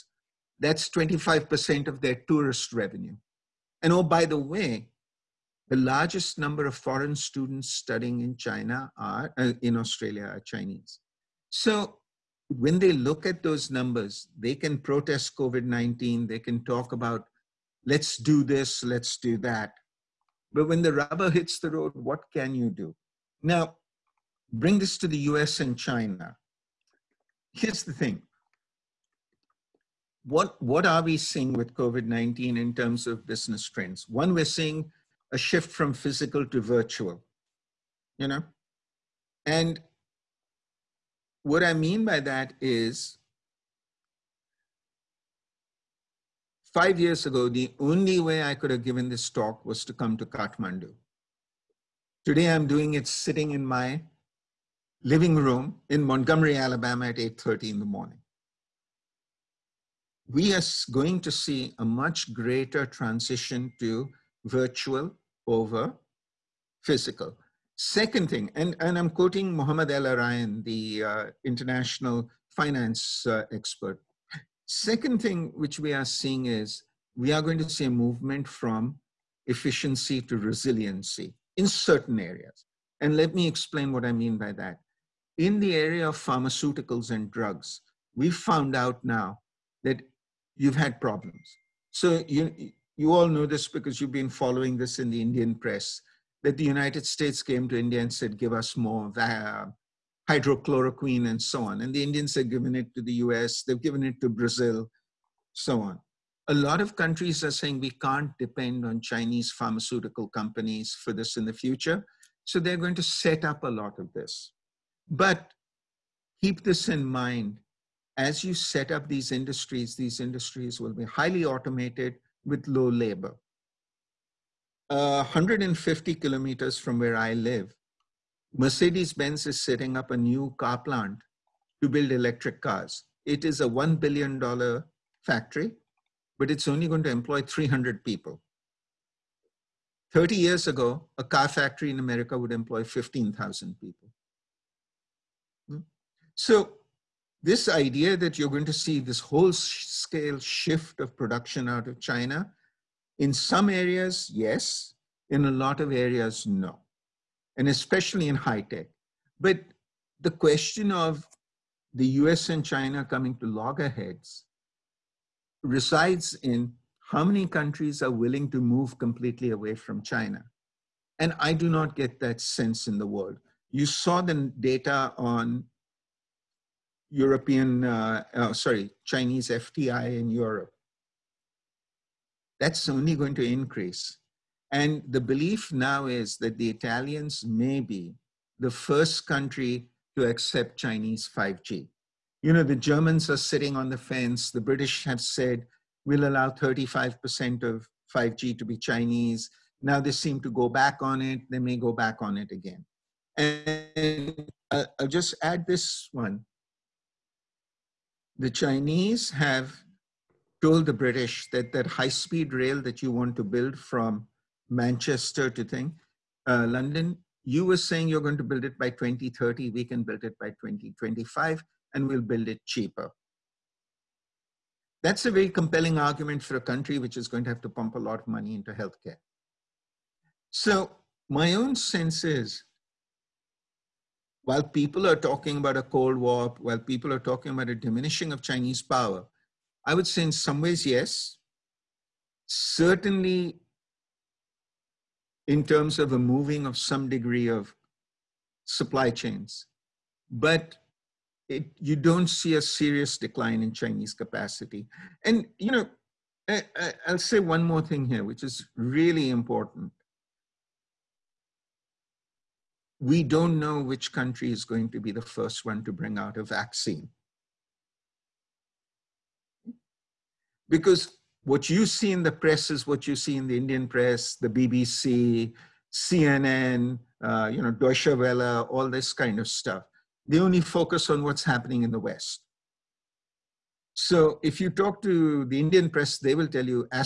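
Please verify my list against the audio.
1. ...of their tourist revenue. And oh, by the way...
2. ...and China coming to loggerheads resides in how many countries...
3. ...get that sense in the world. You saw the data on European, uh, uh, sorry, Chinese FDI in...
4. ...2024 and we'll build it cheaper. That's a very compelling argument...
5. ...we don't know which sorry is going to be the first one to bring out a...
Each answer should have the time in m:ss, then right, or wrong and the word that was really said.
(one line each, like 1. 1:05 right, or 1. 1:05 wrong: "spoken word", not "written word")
1. 0:01 right
2. 2:42 right
3. 2:51 right
4. 3:40 wrong: "2025", not "2024"
5. 4:23 wrong: "country", not "sorry".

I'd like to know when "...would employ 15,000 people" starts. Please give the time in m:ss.
2:22.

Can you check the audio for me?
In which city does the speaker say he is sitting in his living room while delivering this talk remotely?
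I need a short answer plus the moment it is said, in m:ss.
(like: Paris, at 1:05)
Montgomery, Alabama, at 0:56.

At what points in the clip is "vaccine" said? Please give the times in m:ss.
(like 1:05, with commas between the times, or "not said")
4:26.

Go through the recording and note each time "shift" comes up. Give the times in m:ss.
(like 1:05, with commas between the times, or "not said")
0:35, 2:30.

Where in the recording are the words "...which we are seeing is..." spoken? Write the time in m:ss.
1:15.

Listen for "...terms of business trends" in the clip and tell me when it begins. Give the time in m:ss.
0:32.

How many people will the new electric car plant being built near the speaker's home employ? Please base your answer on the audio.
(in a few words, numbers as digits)
300.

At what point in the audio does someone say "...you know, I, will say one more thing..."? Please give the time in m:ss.
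4:15.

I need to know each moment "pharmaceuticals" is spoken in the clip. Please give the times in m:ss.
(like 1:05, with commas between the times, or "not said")
1:26, 1:49.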